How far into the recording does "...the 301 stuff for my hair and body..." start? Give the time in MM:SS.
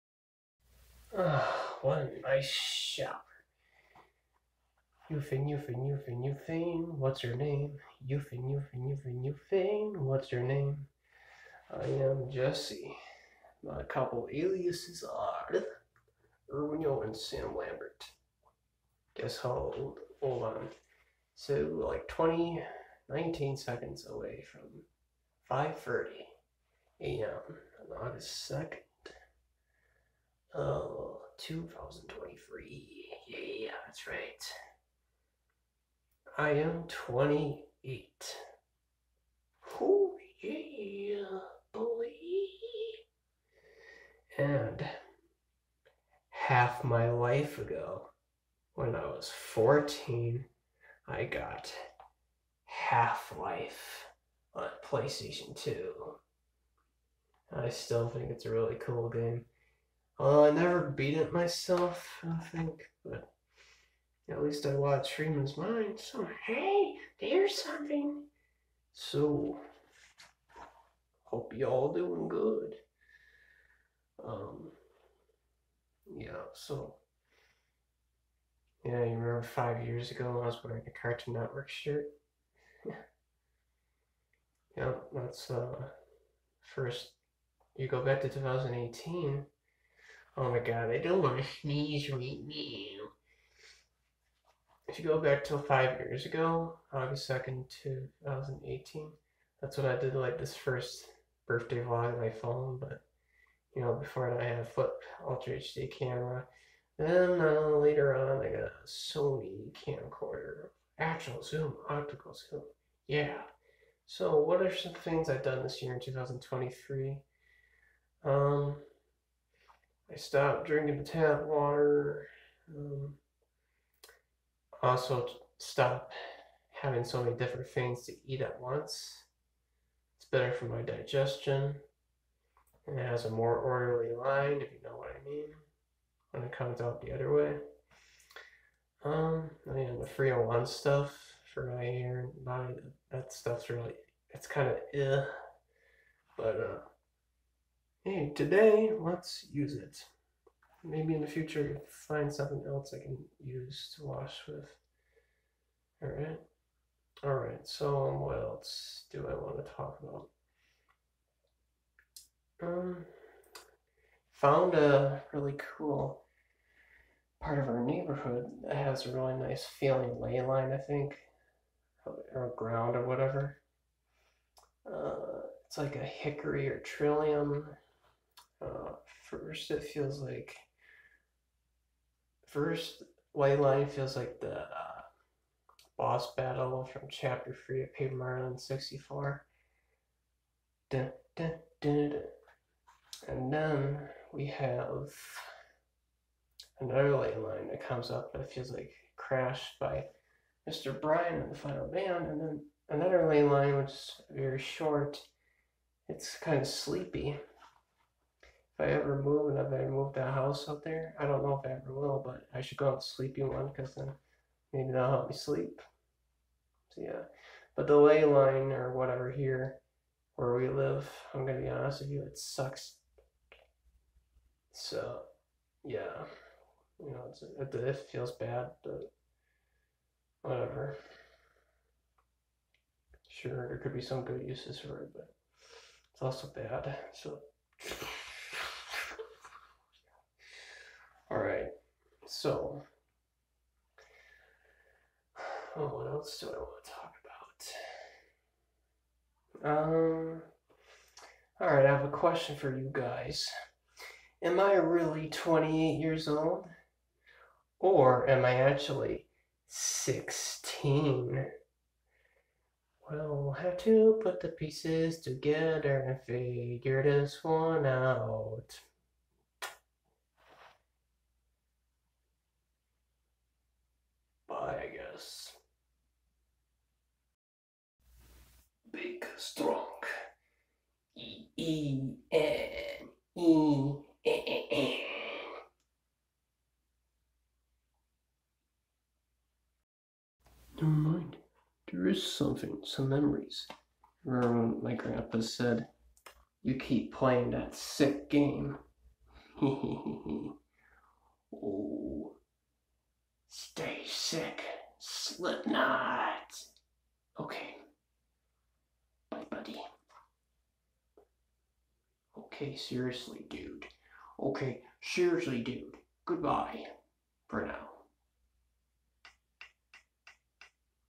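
02:19.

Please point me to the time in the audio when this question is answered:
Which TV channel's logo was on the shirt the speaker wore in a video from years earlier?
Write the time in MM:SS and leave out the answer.
01:20.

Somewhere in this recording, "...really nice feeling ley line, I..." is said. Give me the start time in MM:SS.
02:49.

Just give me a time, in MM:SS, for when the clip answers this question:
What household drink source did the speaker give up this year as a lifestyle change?
02:01.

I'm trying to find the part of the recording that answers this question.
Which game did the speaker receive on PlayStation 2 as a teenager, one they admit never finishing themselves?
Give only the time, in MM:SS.
00:52.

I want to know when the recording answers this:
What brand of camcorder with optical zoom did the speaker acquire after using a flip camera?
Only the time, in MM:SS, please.
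01:48.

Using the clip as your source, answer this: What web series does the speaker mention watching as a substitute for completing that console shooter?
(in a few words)
Freeman's Mind.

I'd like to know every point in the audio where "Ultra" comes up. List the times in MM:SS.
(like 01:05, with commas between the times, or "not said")
01:45.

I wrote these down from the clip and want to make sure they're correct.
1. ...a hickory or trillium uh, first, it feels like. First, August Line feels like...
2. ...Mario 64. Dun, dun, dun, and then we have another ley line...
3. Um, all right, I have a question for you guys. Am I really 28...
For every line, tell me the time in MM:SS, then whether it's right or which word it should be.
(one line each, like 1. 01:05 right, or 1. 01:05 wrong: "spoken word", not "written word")
1. 02:55 wrong: "White", not "August"
2. 03:08 right
3. 04:09 right.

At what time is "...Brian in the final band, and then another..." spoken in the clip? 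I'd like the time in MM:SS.
03:20.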